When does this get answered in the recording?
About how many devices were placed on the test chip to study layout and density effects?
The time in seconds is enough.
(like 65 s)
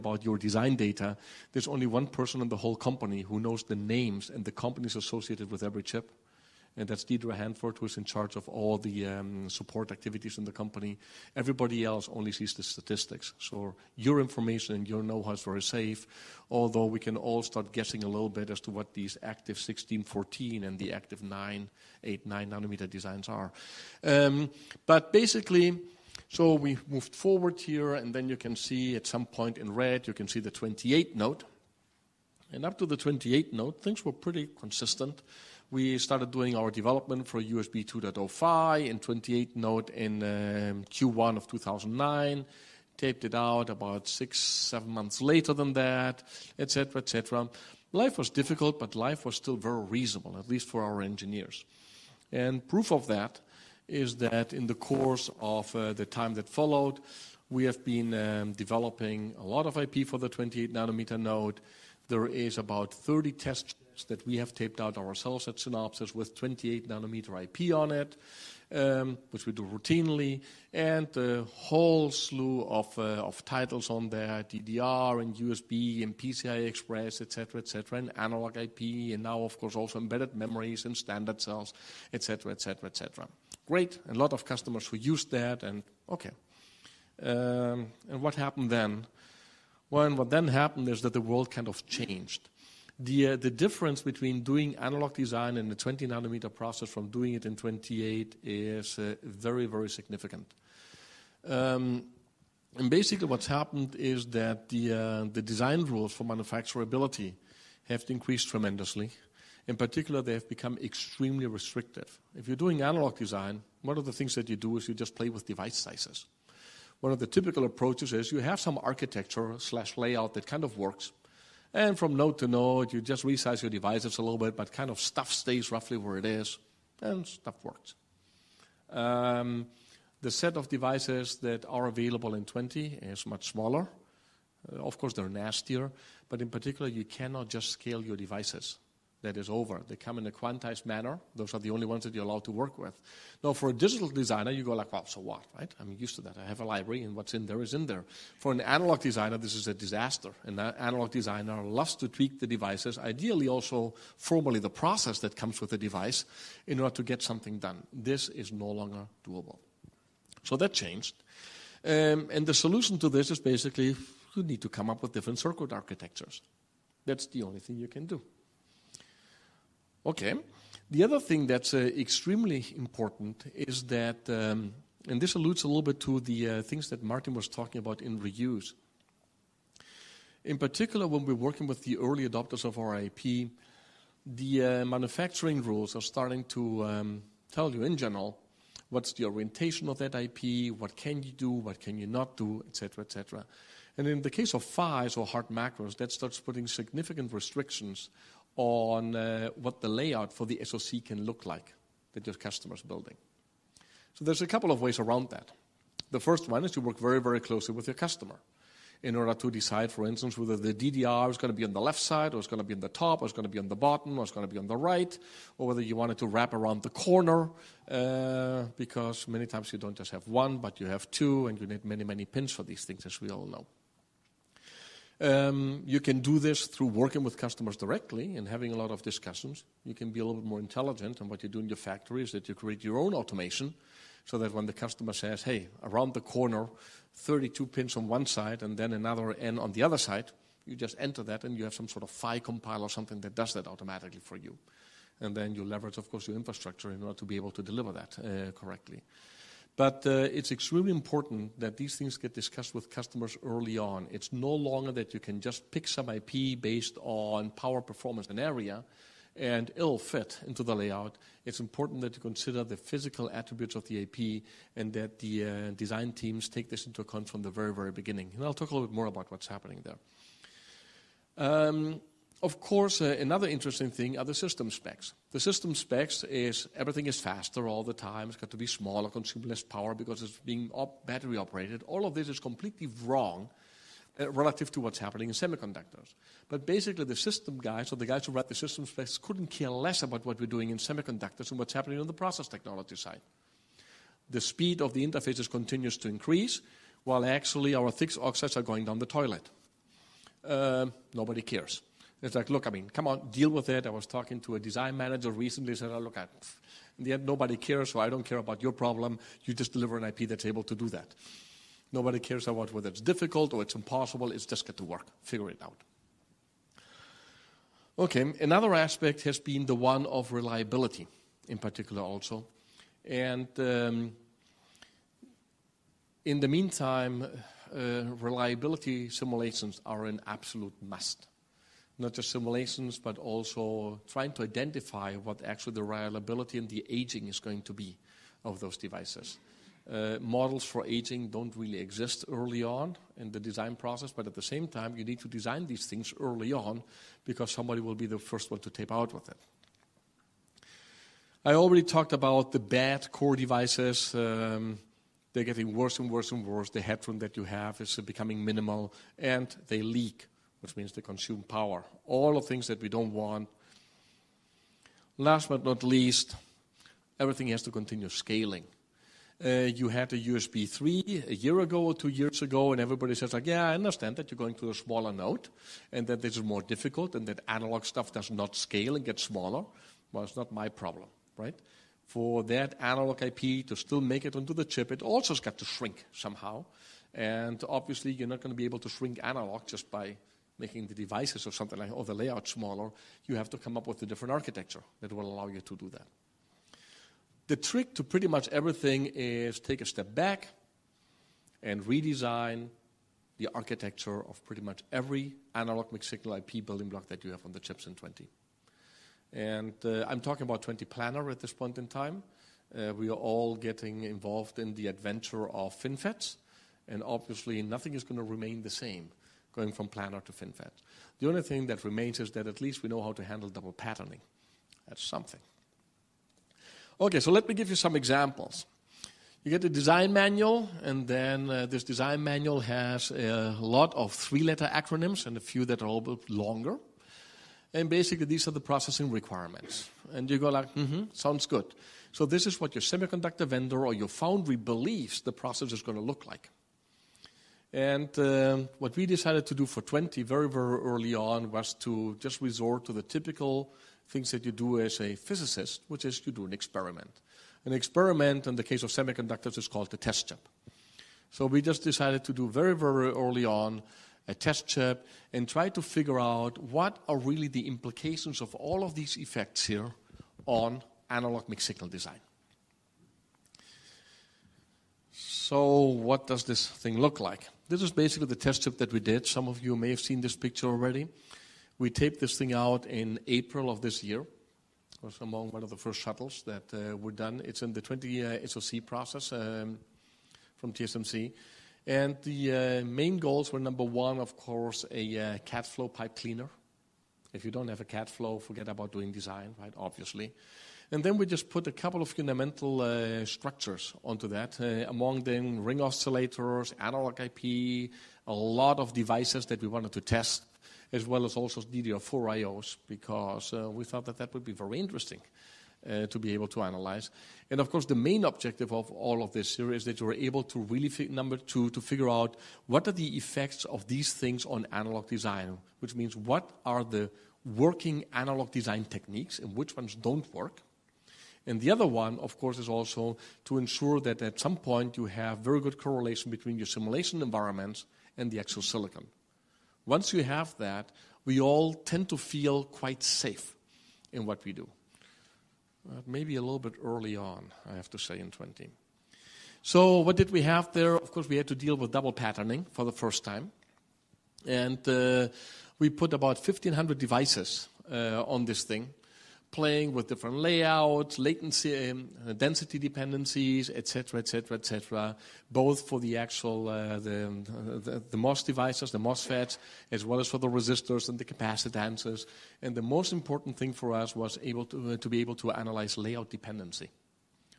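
556 s.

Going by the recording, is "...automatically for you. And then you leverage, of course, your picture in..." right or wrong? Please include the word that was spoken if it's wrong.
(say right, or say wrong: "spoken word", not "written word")
wrong: "infrastructure", not "picture".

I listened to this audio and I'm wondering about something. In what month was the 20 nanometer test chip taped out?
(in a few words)
April.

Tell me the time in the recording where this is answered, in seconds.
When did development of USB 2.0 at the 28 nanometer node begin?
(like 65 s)
40 s.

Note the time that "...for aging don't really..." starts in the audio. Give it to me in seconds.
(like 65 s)
340 s.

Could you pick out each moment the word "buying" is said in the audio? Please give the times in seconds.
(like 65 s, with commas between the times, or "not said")
not said.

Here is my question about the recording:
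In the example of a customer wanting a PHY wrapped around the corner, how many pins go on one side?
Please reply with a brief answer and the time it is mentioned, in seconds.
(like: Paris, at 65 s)
32, at 237 s.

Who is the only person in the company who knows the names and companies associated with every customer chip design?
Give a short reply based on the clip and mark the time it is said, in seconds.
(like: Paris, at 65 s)
Deirdre Hanford, at 7 s.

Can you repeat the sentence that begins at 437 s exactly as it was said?
And basically, these are the processing requirements.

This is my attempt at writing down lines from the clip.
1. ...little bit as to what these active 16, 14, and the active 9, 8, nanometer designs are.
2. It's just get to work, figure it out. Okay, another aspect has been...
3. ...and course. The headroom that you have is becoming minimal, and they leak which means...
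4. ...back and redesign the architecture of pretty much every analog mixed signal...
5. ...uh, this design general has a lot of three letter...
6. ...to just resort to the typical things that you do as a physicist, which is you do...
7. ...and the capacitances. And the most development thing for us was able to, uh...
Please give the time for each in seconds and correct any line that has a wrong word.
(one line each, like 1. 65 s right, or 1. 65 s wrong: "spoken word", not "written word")
1. 18 s right
2. 314 s right
3. 356 s wrong: "worse", not "course"
4. 400 s right
5. 431 s wrong: "manual", not "general"
6. 451 s right
7. 571 s wrong: "important", not "development".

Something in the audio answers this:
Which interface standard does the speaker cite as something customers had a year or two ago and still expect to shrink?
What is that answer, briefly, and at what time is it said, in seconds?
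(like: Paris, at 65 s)
USB 3, at 370 s.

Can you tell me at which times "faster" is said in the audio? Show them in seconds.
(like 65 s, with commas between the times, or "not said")
277 s.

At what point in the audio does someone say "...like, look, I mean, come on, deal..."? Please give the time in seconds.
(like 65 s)
302 s.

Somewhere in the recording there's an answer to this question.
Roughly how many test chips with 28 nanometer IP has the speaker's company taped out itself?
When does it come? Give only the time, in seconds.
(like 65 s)
62 s.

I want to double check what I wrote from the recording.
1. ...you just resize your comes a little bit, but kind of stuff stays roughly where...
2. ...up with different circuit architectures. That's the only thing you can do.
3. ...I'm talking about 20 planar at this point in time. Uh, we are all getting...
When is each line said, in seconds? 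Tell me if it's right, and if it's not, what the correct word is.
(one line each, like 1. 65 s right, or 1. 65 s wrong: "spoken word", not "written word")
1. 122 s wrong: "devices", not "comes"
2. 164 s right
3. 410 s right.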